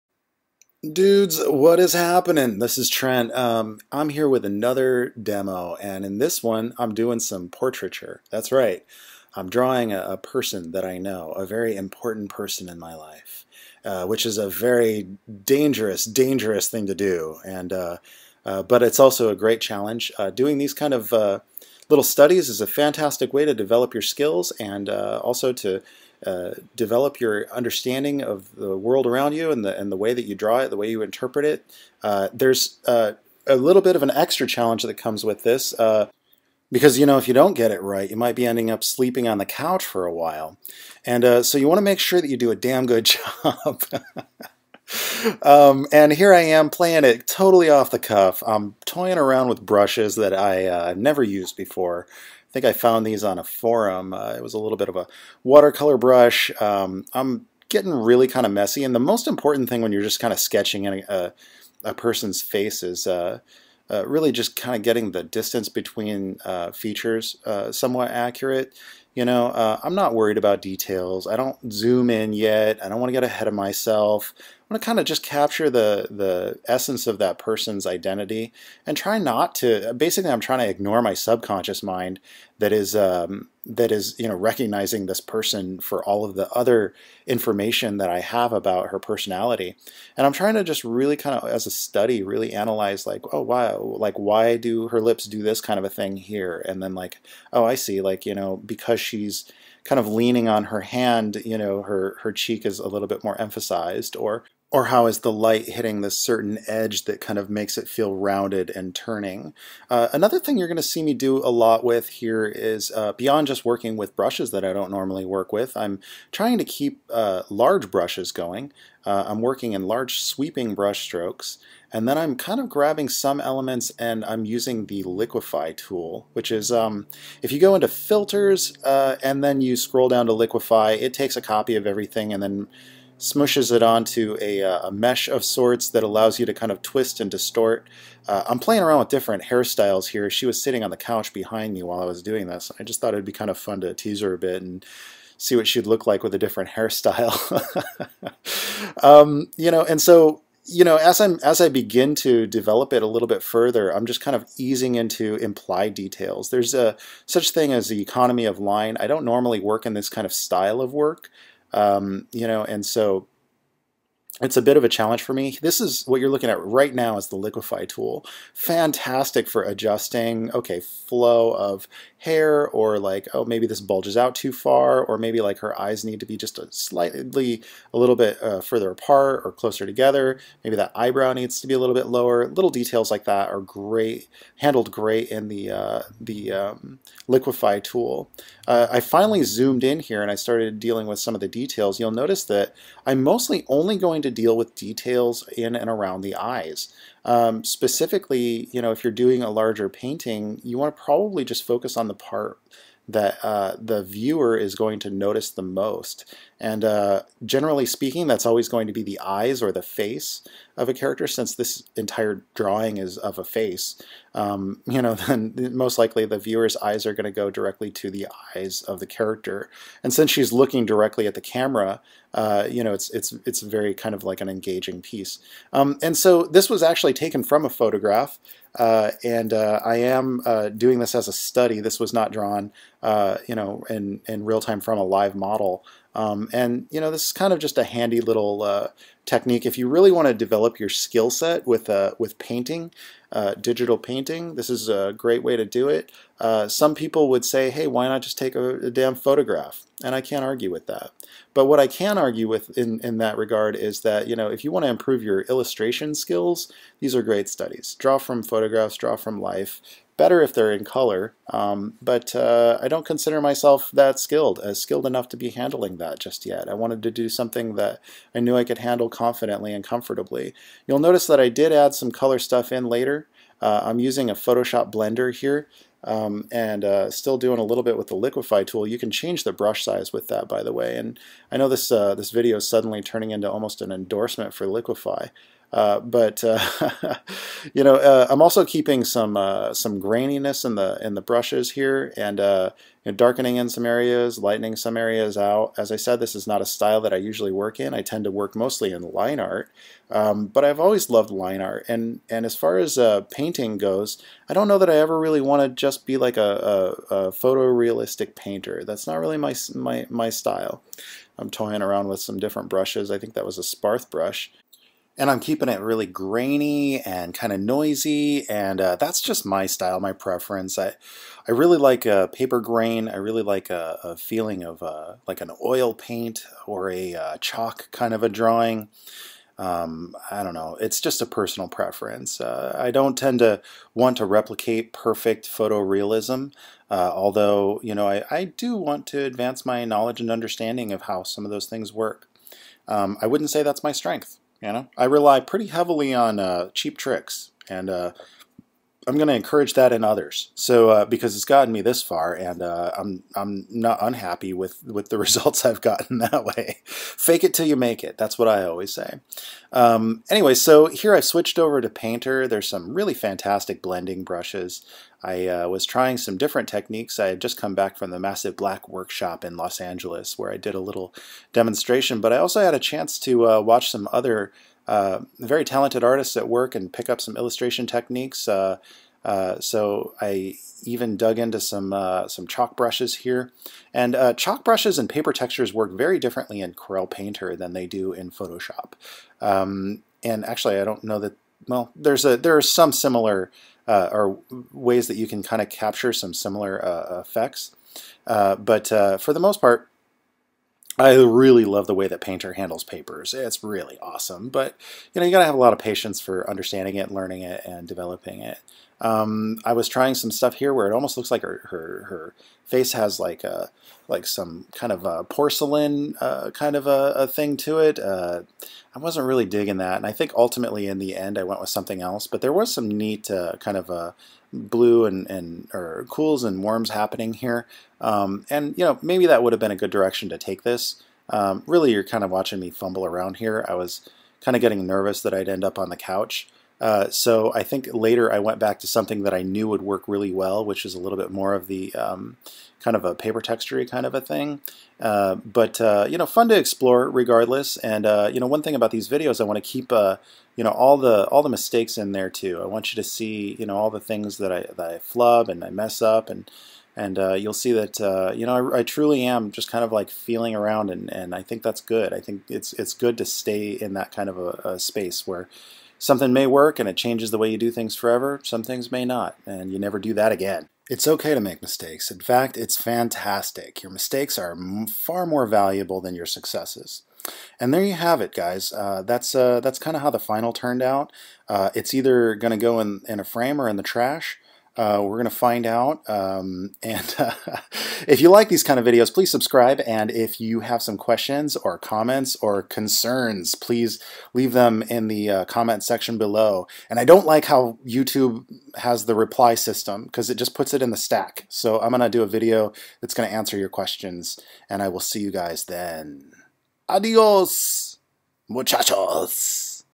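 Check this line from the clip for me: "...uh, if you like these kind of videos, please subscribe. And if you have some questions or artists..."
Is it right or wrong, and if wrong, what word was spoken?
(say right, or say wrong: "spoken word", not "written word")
wrong: "comments", not "artists".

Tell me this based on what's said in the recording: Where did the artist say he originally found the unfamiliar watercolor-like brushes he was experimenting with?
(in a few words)
A forum.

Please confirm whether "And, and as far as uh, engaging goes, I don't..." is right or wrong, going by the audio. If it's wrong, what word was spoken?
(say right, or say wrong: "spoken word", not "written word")
wrong: "painting", not "engaging".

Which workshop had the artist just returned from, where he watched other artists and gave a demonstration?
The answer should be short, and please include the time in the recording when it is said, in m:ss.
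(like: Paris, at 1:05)
Massive Black, at 6:08.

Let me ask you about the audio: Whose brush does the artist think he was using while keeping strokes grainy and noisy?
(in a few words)
Sparth.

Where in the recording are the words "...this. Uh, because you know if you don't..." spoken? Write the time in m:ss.
0:35.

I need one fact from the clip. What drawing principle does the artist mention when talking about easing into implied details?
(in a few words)
Economy of line.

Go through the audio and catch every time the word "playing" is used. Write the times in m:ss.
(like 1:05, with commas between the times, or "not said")
0:46, 2:18.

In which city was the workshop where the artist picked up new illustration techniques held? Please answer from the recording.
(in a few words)
Los Angeles.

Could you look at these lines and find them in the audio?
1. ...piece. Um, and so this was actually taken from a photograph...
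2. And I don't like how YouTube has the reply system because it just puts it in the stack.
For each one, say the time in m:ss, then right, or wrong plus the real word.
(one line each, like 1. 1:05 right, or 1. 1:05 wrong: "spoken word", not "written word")
1. 3:45 right
2. 8:16 right.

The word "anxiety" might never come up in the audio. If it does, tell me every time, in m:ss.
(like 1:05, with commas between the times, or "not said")
not said.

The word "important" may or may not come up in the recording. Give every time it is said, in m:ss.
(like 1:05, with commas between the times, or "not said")
0:11, 0:59.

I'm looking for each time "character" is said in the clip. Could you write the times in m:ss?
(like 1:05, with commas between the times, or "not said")
3:30, 3:39.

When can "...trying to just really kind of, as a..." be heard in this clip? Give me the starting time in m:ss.
1:30.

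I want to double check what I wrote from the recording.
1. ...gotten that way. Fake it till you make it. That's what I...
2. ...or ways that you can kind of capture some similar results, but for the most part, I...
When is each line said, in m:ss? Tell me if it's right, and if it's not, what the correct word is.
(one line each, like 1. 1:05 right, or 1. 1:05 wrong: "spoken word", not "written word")
1. 5:55 right
2. 6:33 wrong: "effects", not "results".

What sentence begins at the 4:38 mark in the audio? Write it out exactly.
You can change the brush size with that, by the way.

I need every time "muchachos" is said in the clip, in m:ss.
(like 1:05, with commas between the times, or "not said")
8:28.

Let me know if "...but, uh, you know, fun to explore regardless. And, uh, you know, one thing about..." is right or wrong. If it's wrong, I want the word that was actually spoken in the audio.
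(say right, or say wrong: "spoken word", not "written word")
right.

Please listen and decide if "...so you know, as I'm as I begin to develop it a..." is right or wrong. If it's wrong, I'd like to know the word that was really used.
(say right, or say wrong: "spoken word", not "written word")
right.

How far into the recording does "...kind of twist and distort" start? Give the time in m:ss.
2:16.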